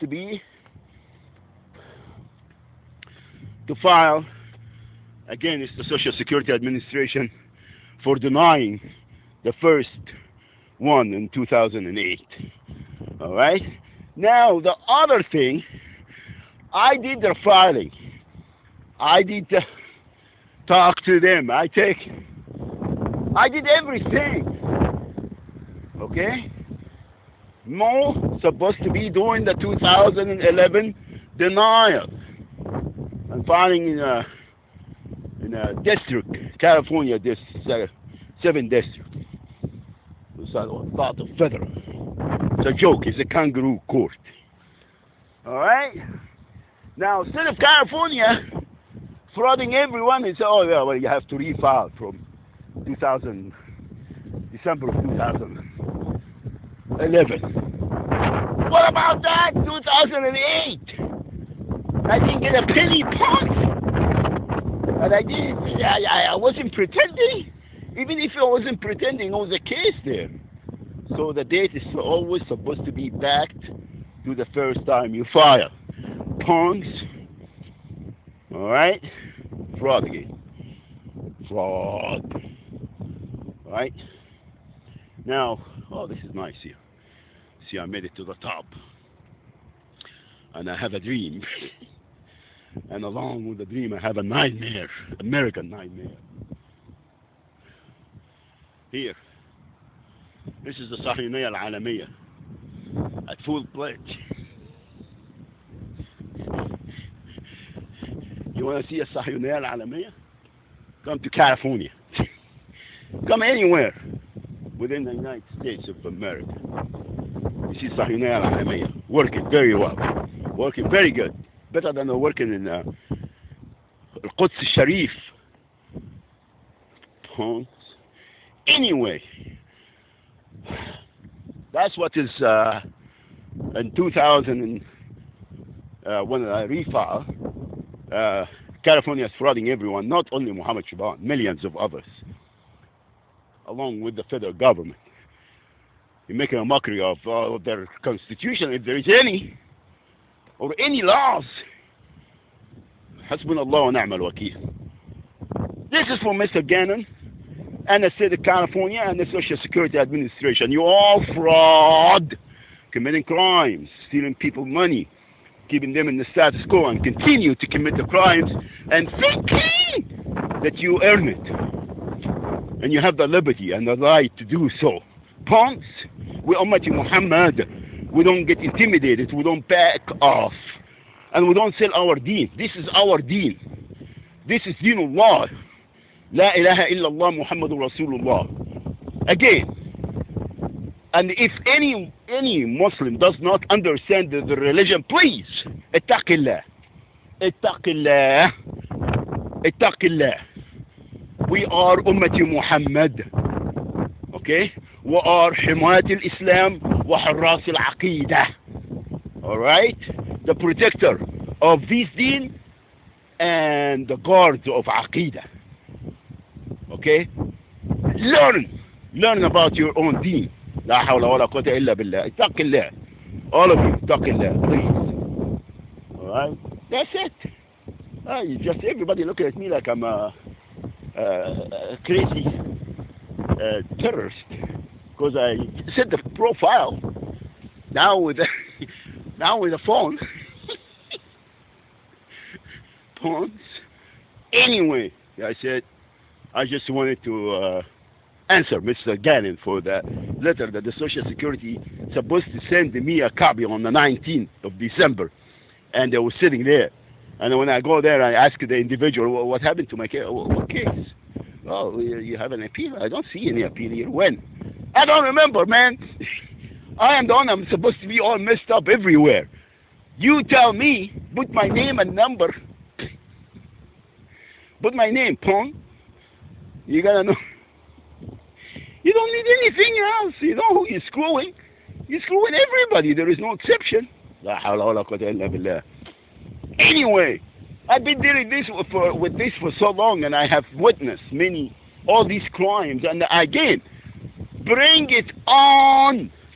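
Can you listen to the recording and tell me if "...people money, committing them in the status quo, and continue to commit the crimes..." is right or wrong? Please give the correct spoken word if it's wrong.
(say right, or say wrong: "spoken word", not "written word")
wrong: "keeping", not "committing".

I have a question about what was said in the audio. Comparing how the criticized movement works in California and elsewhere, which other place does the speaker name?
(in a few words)
Al-Quds Sharif.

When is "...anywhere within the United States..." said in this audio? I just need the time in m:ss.
1:53.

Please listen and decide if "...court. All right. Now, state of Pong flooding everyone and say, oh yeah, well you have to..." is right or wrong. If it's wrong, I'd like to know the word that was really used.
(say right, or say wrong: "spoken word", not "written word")
wrong: "California", not "Pong".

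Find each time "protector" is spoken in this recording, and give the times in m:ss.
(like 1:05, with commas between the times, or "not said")
3:30.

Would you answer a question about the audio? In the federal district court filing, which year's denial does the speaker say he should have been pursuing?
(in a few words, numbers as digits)
2011.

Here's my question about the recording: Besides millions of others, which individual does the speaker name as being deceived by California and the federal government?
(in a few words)
Muhammad Shaban.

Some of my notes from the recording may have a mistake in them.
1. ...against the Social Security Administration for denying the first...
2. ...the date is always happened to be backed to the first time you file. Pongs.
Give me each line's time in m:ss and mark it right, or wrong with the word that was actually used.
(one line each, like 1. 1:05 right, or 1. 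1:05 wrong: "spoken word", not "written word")
1. 0:05 right
2. 1:11 wrong: "supposed", not "happened".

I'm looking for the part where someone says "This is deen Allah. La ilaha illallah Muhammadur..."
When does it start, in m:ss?
3:04.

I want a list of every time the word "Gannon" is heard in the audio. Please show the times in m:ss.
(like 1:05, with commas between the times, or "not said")
2:36, 4:09.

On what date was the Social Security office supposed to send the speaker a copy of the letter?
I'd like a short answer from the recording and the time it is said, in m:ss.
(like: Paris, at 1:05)
19 December, at 4:13.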